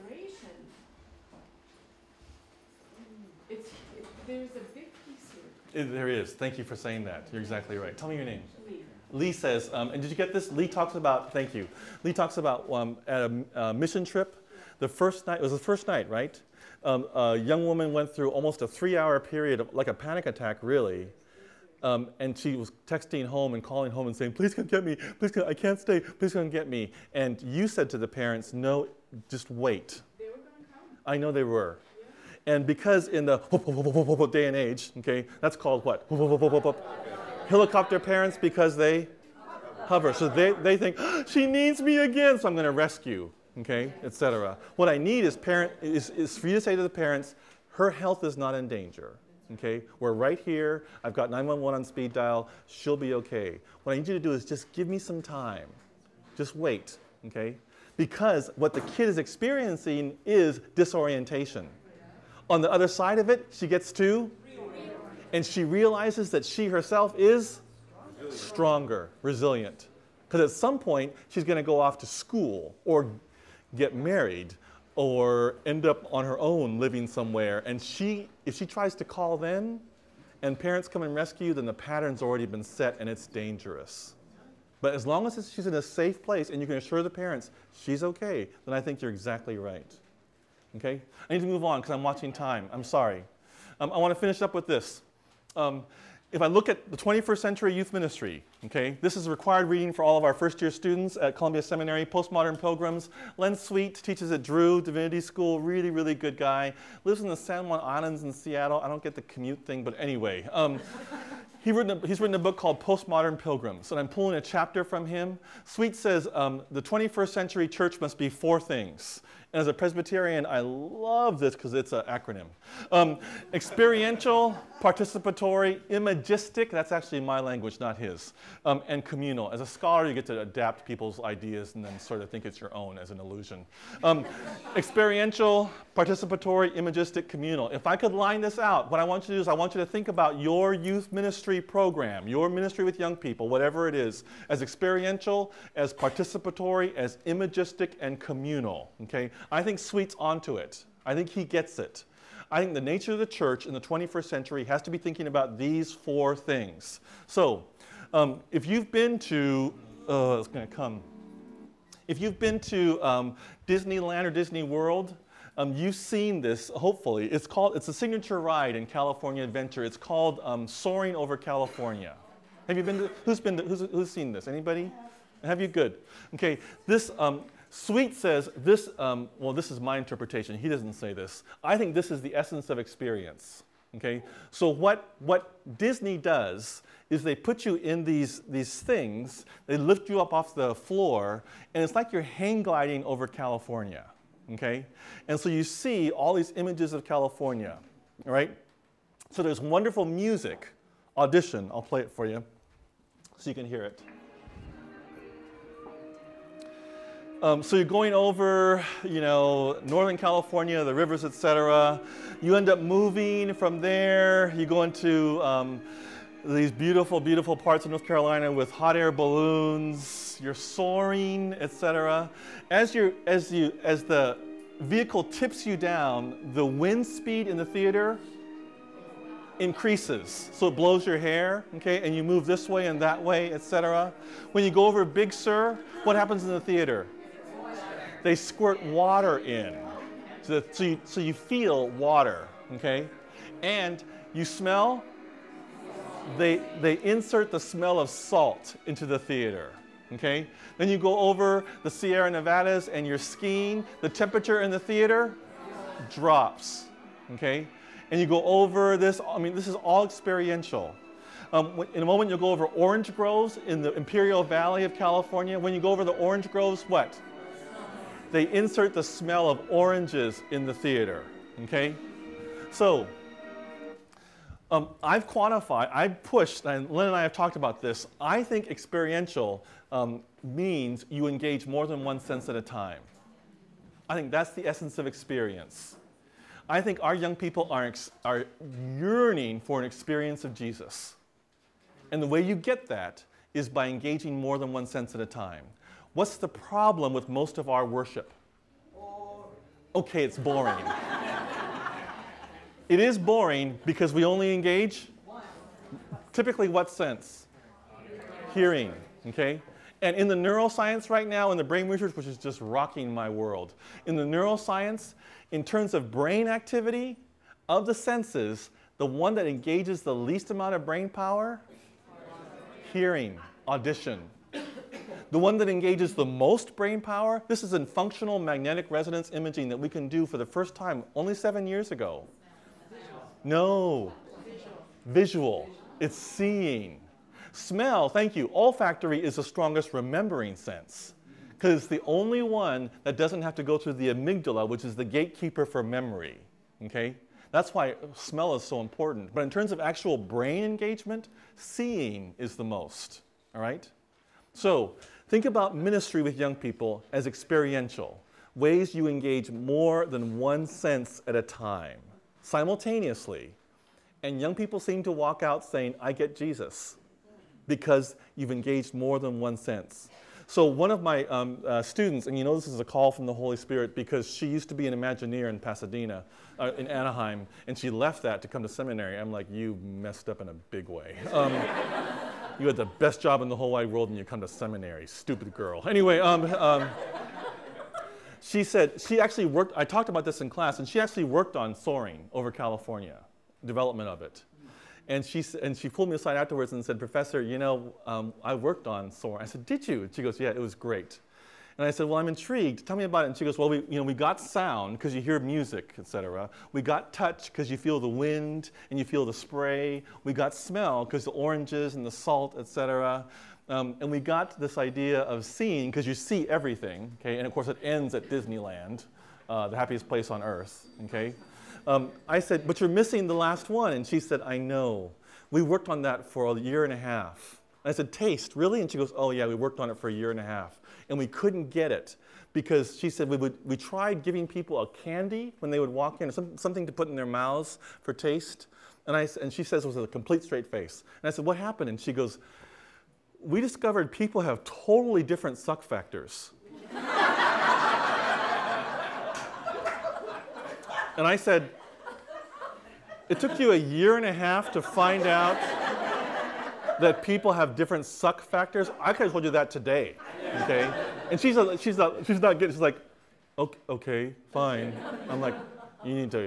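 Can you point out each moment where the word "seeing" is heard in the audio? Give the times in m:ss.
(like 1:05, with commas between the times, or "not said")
5:36, 5:51, 6:55.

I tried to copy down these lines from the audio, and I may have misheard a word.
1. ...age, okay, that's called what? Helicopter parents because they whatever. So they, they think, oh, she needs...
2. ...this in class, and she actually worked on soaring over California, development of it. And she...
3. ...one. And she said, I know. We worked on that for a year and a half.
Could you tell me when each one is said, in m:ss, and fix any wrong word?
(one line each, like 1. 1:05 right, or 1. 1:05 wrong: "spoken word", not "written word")
1. 0:34 wrong: "hover", not "whatever"
2. 6:30 right
3. 7:03 right.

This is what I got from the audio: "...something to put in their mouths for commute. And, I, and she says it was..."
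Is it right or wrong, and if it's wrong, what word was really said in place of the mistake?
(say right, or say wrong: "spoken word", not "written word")
wrong: "taste", not "commute".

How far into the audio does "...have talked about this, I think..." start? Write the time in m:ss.
4:37.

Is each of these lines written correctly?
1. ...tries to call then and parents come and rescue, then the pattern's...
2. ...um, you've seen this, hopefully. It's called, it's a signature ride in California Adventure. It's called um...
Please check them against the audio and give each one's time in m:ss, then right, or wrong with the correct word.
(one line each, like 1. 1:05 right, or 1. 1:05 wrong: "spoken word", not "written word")
1. 1:18 right
2. 2:45 right.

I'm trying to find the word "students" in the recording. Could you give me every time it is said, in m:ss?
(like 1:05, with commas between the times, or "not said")
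1:40, 6:11.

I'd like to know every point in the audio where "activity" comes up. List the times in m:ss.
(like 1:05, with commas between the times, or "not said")
5:16.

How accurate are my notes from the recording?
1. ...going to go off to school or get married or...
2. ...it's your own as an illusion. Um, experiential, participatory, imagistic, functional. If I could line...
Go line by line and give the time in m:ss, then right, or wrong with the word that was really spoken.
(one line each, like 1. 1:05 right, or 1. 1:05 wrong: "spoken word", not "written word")
1. 1:11 right
2. 2:12 wrong: "communal", not "functional".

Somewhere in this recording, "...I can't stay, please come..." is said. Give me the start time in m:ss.
0:25.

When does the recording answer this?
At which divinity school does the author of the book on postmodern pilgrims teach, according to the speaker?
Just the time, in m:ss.
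1:44.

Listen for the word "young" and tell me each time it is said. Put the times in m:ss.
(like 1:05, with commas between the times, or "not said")
0:17, 2:22, 4:47, 5:56, 6:04.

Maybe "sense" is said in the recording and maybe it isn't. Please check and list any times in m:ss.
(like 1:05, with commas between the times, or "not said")
4:42, 4:54, 5:06, 5:17, 5:40, 6:00, 6:09.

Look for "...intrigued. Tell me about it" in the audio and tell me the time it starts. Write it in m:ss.
6:42.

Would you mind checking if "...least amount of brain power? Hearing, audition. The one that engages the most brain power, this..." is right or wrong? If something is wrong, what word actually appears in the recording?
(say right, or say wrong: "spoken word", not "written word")
right.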